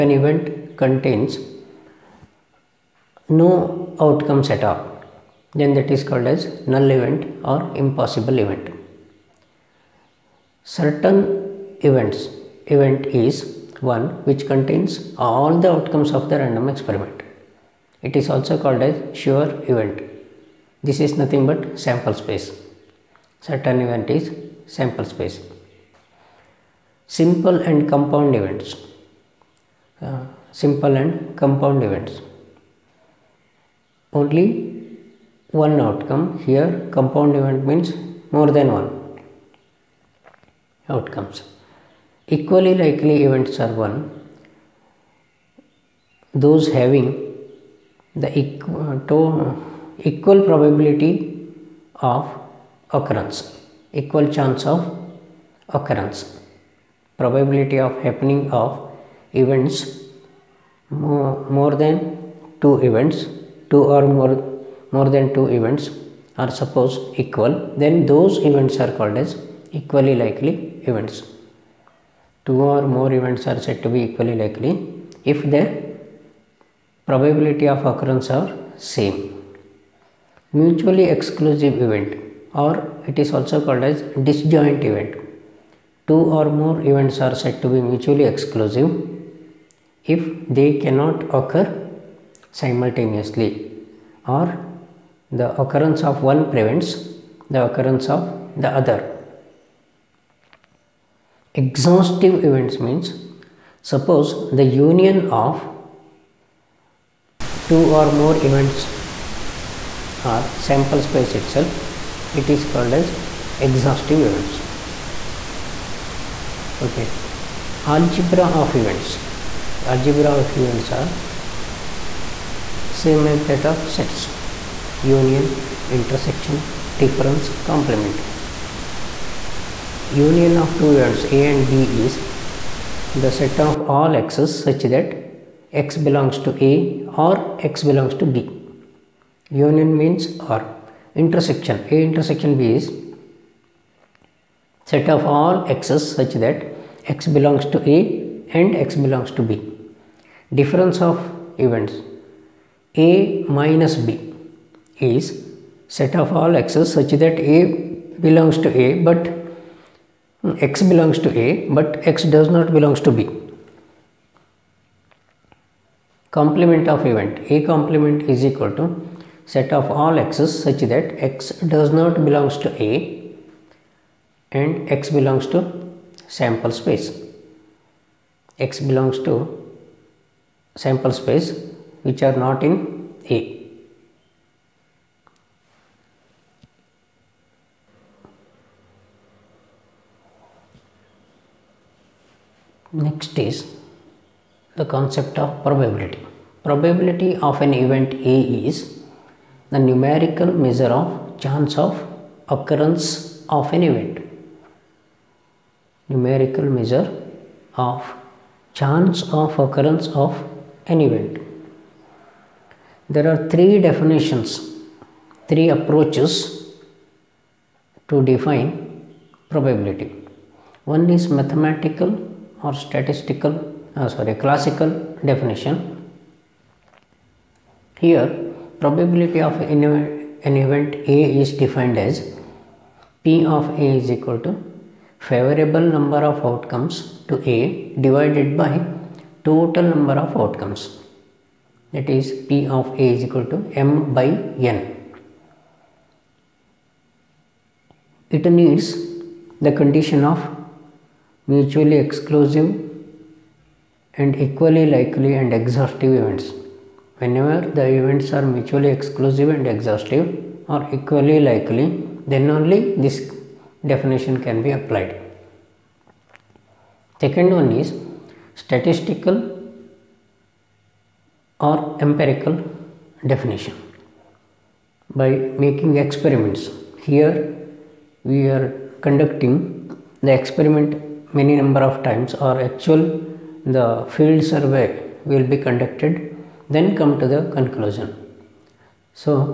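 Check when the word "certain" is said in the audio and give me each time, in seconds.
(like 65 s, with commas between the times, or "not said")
10 s, 23 s.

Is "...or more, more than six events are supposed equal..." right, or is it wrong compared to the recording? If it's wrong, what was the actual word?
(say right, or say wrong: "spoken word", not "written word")
wrong: "two", not "six".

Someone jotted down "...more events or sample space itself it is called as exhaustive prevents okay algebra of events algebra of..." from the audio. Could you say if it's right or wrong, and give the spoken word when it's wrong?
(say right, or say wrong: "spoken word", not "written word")
wrong: "events", not "prevents".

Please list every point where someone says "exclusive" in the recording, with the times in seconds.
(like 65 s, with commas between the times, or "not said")
81 s, 88 s, 252 s, 258 s.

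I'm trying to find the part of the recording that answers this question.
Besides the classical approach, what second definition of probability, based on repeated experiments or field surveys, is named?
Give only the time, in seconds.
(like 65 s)
268 s.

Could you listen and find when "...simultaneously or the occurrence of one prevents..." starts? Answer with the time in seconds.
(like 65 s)
92 s.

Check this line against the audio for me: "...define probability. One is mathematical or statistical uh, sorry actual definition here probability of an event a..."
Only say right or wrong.
wrong.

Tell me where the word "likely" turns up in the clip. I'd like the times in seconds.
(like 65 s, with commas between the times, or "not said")
42 s, 70 s, 74 s, 254 s, 261 s.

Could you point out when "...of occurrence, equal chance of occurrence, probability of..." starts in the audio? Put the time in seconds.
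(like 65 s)
52 s.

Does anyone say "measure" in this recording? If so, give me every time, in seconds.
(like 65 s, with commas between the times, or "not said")
200 s, 206 s.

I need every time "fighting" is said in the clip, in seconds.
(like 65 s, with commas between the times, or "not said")
not said.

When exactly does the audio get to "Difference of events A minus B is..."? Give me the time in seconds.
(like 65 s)
150 s.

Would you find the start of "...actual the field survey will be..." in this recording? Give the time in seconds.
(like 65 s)
282 s.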